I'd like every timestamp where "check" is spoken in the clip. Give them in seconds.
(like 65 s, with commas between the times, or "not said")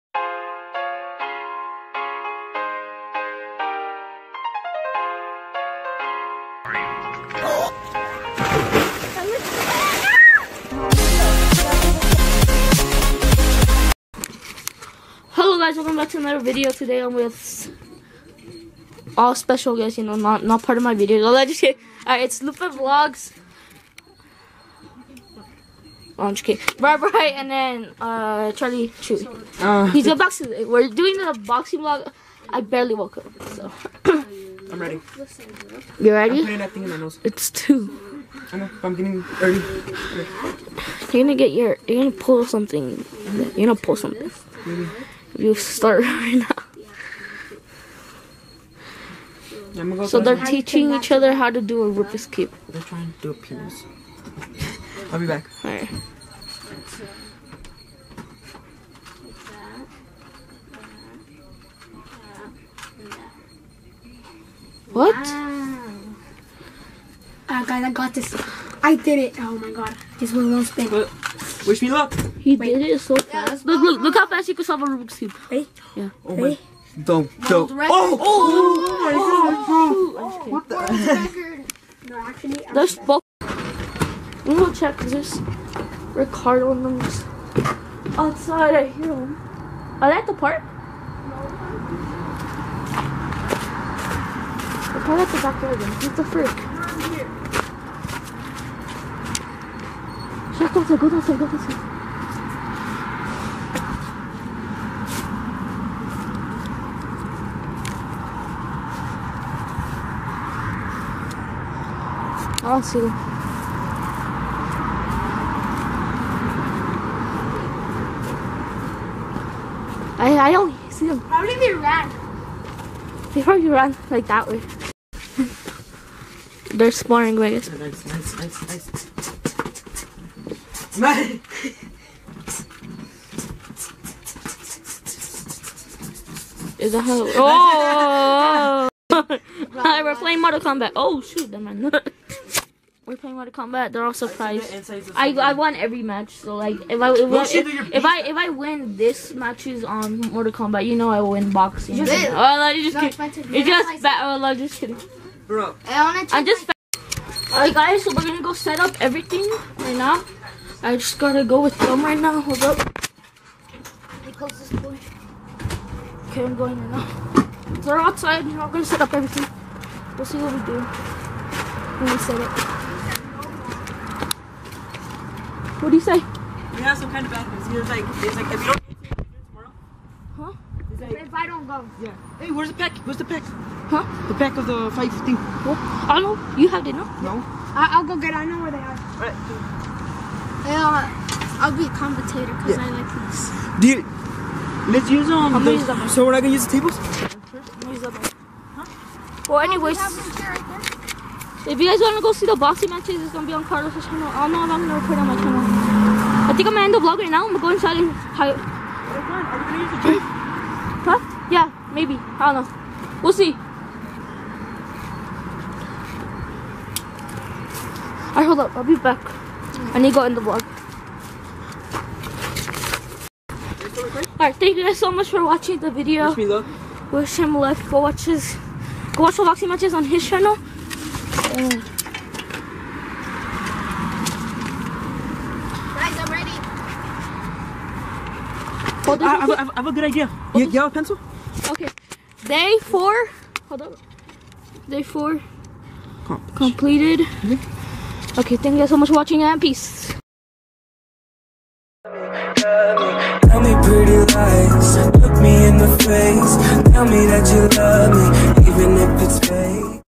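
84 s, 100 s.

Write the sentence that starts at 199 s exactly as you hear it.
Oh, we if you guys want to go see the boxing matches, it's going to be on Carlos' channel.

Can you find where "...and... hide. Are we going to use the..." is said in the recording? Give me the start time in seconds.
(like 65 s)
207 s.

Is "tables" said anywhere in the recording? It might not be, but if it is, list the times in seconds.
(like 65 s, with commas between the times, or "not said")
196 s.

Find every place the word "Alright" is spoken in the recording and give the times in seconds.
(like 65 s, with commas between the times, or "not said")
22 s, 55 s, 157 s, 218 s, 224 s.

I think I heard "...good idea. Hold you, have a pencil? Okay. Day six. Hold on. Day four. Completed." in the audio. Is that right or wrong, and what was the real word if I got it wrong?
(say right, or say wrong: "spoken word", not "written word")
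wrong: "four", not "six".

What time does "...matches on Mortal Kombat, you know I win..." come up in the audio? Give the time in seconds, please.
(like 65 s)
149 s.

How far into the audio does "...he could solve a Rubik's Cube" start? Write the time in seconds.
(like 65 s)
74 s.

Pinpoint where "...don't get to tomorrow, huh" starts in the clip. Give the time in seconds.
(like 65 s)
178 s.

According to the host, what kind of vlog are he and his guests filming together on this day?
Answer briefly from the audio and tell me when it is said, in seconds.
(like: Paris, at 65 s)
Boxing vlog, at 31 s.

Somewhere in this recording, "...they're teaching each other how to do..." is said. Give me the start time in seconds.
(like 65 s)
50 s.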